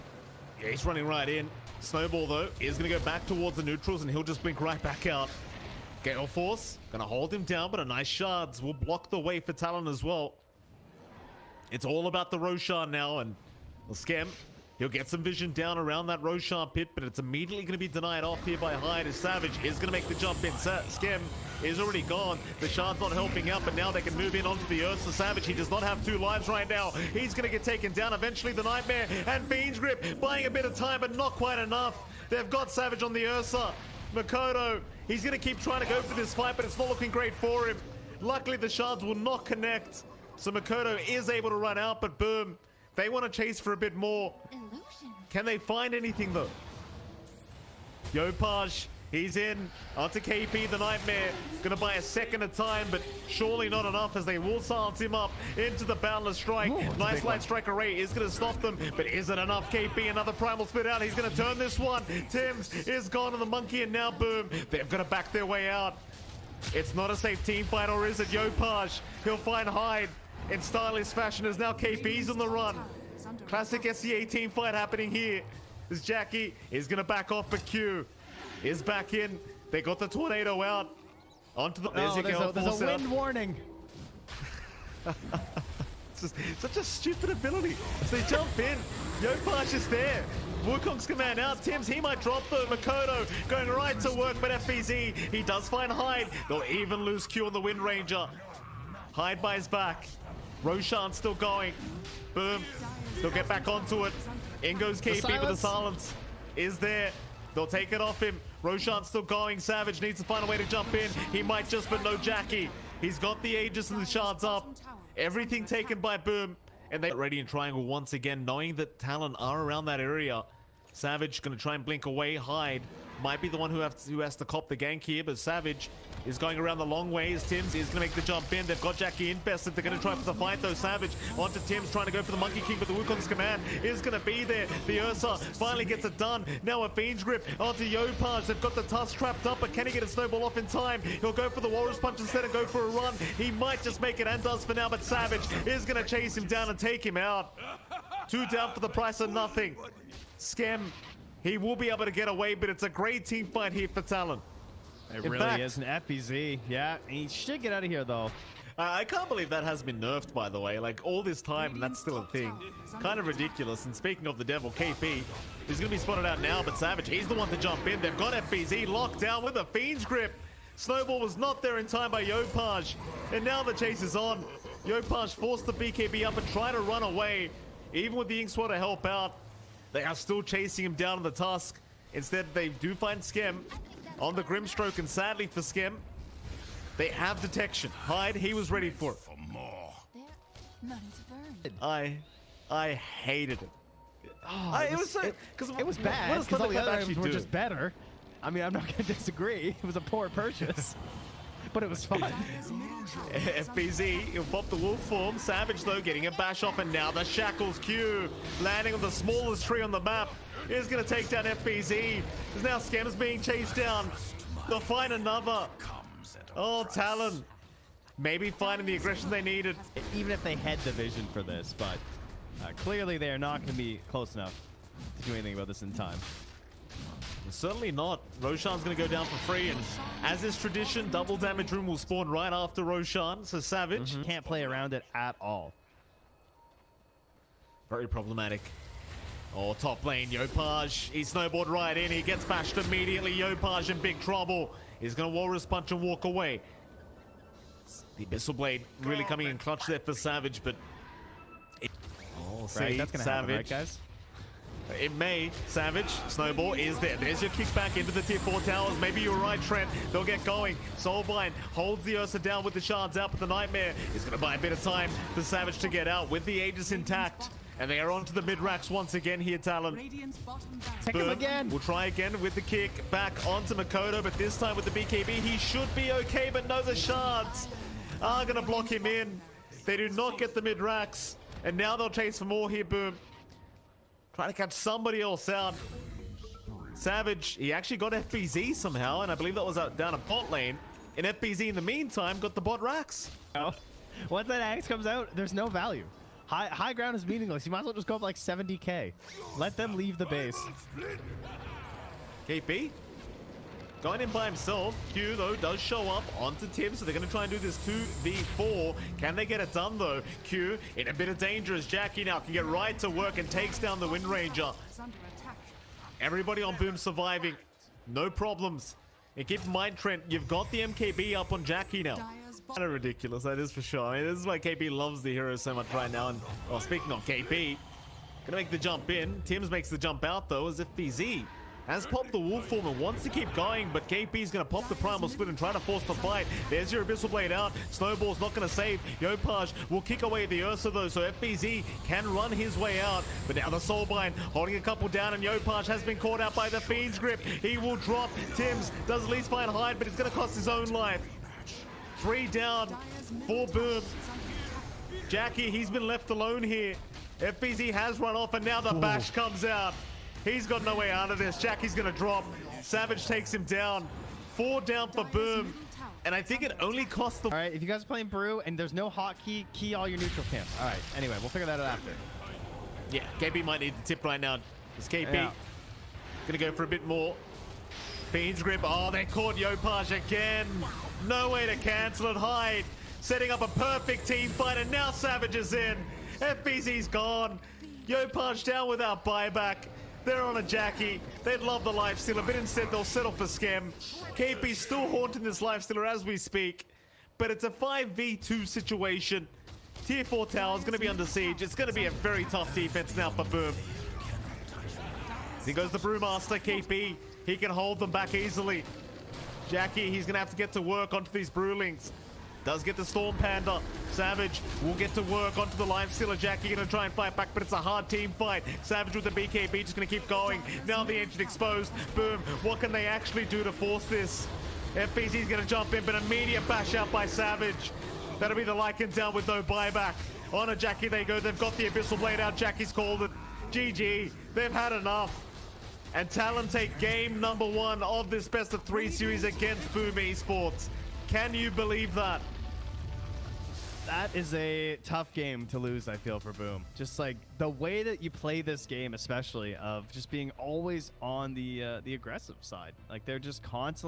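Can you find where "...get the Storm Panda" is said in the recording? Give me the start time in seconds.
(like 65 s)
412 s.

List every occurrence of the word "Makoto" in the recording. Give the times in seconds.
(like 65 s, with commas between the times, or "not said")
34 s, 40 s, 92 s, 273 s.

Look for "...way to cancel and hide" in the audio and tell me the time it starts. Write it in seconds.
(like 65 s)
381 s.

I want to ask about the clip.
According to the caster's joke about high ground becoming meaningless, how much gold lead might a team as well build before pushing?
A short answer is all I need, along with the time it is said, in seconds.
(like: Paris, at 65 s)
70k, at 298 s.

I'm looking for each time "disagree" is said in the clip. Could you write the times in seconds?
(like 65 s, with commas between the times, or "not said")
199 s.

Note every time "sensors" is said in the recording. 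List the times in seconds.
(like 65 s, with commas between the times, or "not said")
not said.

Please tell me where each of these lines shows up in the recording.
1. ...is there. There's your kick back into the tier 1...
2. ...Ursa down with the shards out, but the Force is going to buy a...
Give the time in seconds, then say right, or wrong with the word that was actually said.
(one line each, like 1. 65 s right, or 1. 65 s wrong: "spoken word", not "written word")
1. 256 s wrong: "4", not "1"
2. 262 s wrong: "Nightmare", not "Force".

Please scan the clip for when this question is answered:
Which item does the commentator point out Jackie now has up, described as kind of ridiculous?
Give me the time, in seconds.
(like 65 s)
320 s.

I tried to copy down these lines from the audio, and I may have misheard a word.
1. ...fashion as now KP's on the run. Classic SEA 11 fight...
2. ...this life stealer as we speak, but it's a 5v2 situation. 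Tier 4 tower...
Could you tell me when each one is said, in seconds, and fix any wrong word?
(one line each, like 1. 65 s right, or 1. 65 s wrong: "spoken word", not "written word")
1. 71 s wrong: "18", not "11"
2. 395 s right.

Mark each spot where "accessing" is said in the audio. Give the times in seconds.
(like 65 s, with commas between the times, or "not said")
not said.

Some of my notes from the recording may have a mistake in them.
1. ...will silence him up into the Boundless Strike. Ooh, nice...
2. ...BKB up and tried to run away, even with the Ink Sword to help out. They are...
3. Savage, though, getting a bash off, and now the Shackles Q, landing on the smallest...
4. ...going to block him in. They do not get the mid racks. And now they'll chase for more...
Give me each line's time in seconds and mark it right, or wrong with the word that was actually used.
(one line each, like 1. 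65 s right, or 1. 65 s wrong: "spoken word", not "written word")
1. 54 s right
2. 175 s right
3. 205 s right
4. 278 s right.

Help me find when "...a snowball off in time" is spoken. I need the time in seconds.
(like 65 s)
140 s.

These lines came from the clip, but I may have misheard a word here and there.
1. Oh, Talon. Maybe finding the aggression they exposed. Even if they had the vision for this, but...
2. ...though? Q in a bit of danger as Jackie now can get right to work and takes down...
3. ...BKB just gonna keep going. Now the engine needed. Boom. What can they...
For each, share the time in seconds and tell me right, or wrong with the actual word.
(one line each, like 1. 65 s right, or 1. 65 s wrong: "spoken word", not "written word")
1. 216 s wrong: "needed", not "exposed"
2. 309 s right
3. 419 s wrong: "exposed", not "needed".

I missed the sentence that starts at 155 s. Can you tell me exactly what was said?
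It In really fact, is an FBZ.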